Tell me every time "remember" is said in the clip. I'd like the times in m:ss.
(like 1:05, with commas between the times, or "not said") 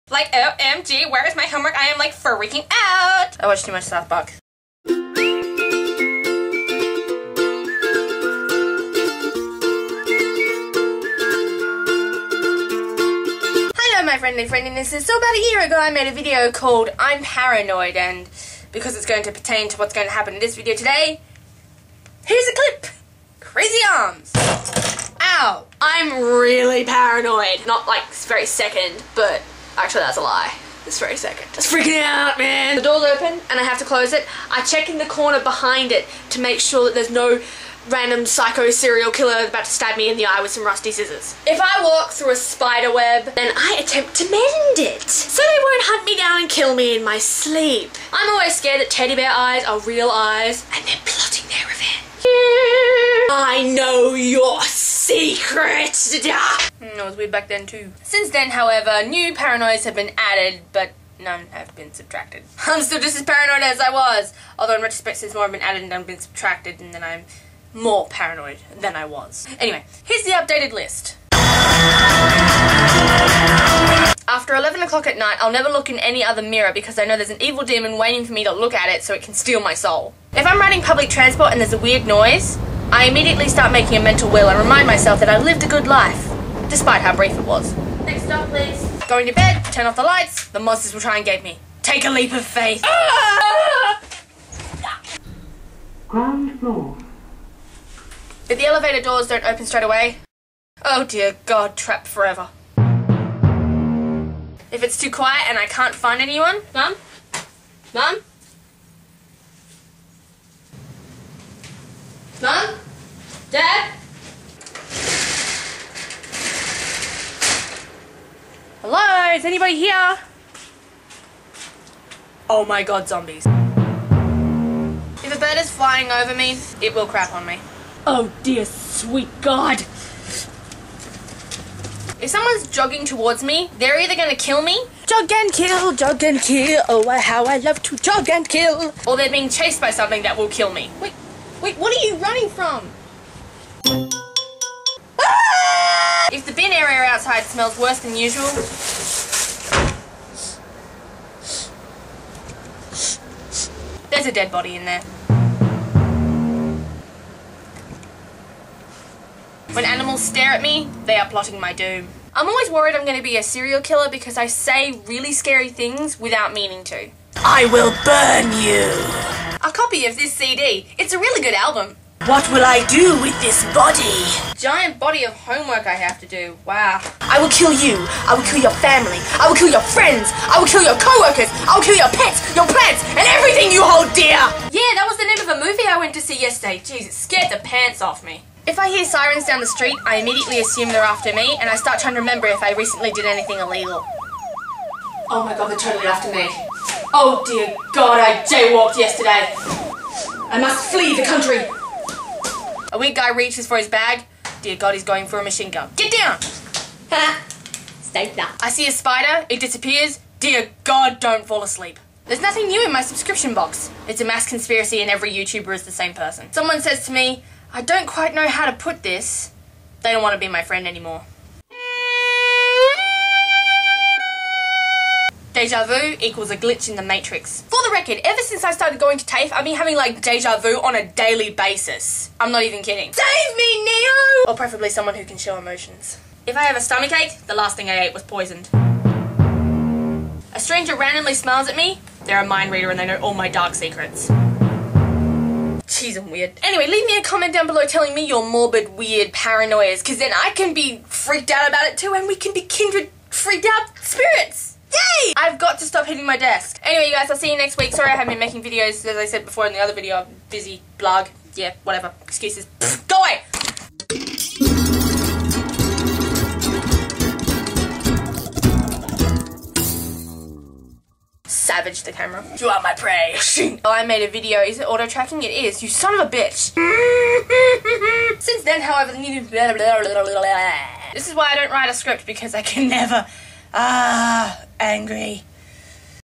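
3:12.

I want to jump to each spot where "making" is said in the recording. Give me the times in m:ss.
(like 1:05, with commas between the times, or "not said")
1:23, 4:18.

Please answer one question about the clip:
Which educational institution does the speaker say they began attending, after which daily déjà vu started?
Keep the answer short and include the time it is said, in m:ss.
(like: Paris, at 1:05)
TAFE, at 3:49.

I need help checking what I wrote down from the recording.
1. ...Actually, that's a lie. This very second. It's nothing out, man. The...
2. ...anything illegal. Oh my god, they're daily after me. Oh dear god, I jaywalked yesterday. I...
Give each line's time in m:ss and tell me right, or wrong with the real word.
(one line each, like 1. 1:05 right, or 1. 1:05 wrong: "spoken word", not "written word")
1. 0:29 wrong: "freaking", not "nothing"
2. 3:13 wrong: "totally", not "daily".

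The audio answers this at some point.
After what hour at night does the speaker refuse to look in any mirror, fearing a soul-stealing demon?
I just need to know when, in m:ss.
1:14.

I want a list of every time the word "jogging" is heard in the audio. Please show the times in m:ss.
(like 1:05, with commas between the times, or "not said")
2:12.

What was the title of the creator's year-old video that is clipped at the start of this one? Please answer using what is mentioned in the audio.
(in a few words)
I'm Paranoid.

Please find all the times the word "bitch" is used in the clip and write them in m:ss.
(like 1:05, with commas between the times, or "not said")
4:36.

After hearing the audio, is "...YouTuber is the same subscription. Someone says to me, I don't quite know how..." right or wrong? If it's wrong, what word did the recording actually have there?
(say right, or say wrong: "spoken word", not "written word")
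wrong: "person", not "subscription".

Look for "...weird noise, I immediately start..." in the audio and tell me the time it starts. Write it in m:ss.
1:21.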